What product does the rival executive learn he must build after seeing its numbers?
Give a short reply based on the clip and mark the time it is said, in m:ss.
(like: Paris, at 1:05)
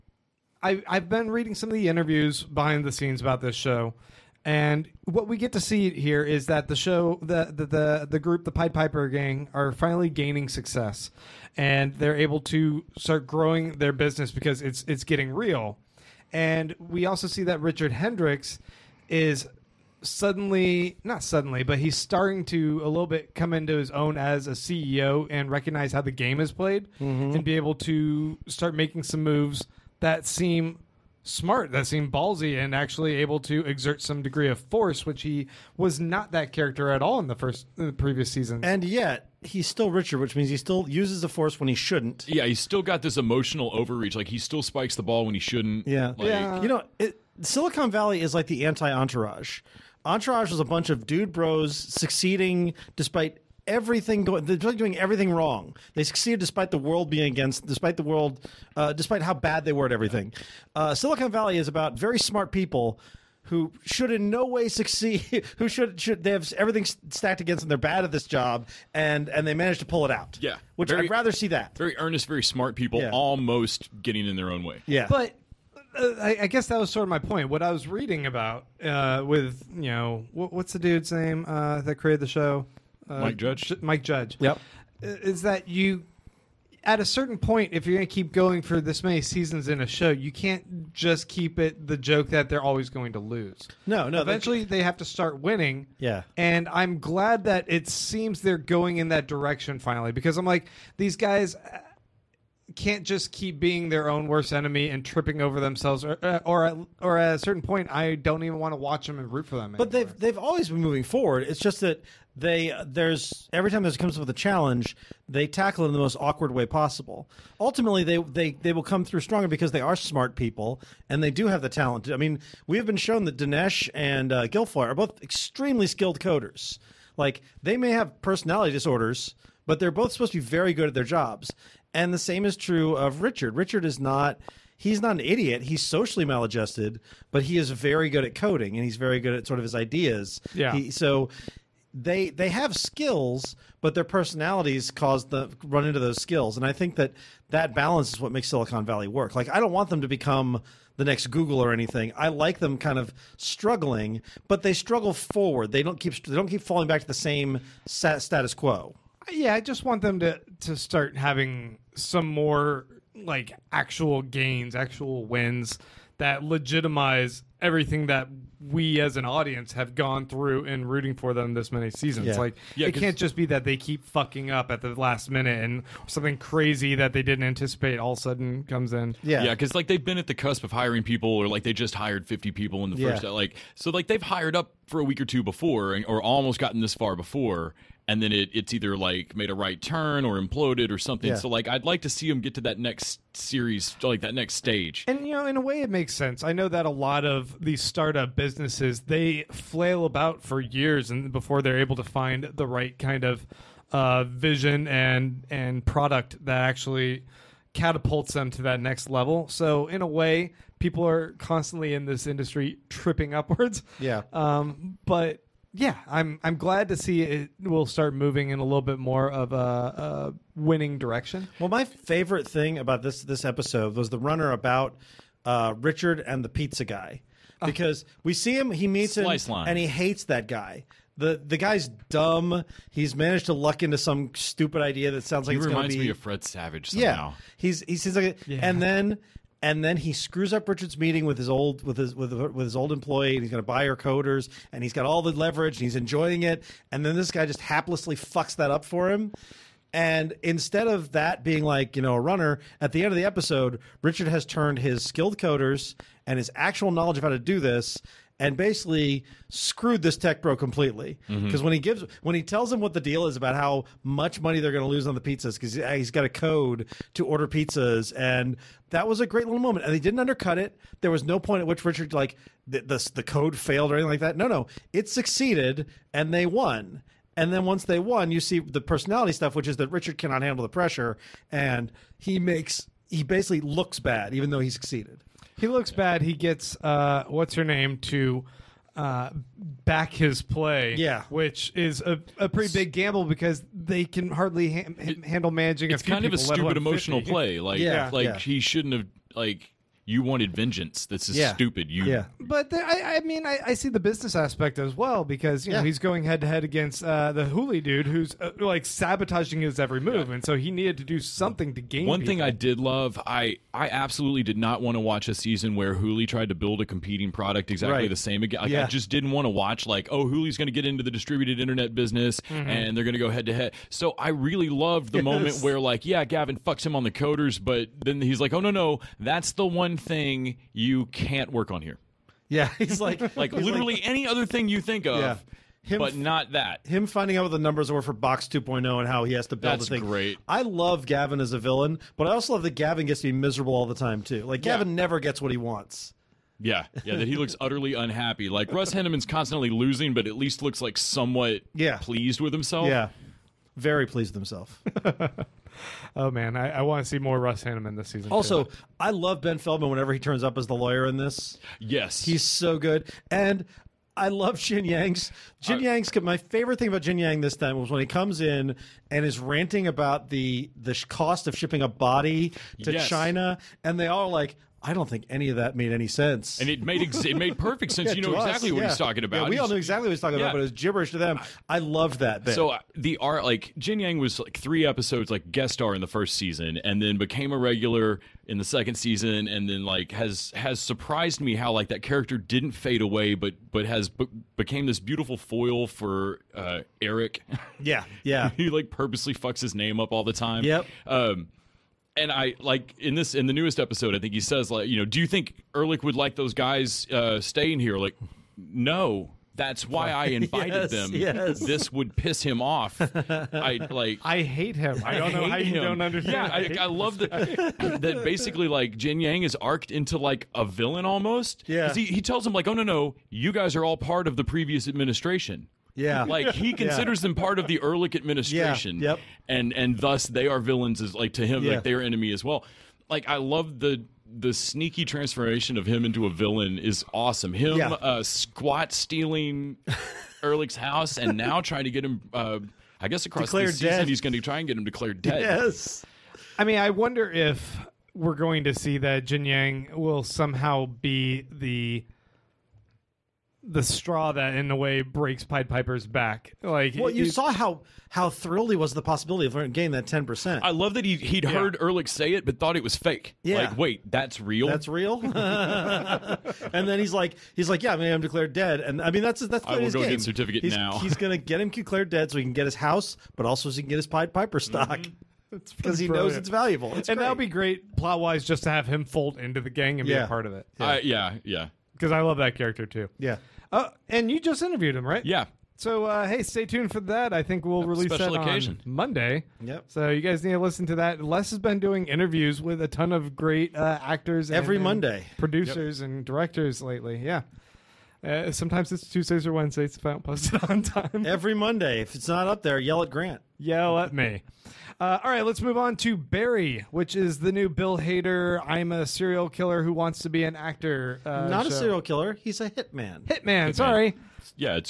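Box 2.0, at 5:38.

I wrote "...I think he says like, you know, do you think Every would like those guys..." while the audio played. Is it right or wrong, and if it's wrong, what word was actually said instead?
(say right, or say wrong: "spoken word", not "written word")
wrong: "Erlich", not "Every".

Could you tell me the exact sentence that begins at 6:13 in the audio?
China, and they all like, I don't think any of that made any sense.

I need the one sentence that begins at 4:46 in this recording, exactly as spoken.
He gets uh, what's her name to uh, back his play.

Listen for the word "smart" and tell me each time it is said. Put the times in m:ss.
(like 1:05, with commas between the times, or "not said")
0:31, 1:02, 1:12, 1:59.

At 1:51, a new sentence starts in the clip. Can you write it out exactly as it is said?
It's just that they there's every time there comes up with a challenge, they tackle it in the most awkward way possible.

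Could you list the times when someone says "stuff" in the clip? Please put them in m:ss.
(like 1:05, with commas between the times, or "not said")
4:39.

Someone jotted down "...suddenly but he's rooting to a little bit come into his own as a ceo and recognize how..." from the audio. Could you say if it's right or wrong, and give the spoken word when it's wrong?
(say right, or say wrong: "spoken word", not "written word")
wrong: "starting", not "rooting".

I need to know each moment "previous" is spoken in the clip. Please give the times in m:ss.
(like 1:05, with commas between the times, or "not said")
0:37, 7:04.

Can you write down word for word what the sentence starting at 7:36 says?
Like, well, you saw how how thrilled he was the possibility of gaining that ten percent.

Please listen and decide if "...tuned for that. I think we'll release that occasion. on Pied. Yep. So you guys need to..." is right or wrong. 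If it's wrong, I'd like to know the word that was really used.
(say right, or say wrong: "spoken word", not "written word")
wrong: "Monday", not "Pied".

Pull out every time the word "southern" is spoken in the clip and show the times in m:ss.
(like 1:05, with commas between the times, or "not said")
not said.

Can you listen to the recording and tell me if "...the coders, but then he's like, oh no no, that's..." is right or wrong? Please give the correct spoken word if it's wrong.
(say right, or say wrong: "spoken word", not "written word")
right.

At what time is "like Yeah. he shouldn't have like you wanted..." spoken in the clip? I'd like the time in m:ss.
4:58.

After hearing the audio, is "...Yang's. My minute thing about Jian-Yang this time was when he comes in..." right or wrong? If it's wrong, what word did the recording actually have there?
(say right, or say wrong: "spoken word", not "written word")
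wrong: "favorite", not "minute".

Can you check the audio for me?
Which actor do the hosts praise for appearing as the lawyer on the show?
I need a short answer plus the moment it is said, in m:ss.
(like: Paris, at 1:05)
Ben Feldman, at 5:59.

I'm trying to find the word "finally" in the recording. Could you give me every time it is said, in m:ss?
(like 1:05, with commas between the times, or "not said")
0:09, 1:39.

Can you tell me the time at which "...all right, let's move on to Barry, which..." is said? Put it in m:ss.
8:25.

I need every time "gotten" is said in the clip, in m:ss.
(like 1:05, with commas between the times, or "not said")
3:06.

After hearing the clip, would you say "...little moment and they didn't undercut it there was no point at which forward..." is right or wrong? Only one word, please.
wrong.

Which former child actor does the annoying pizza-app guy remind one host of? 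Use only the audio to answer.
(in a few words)
Fred Savage.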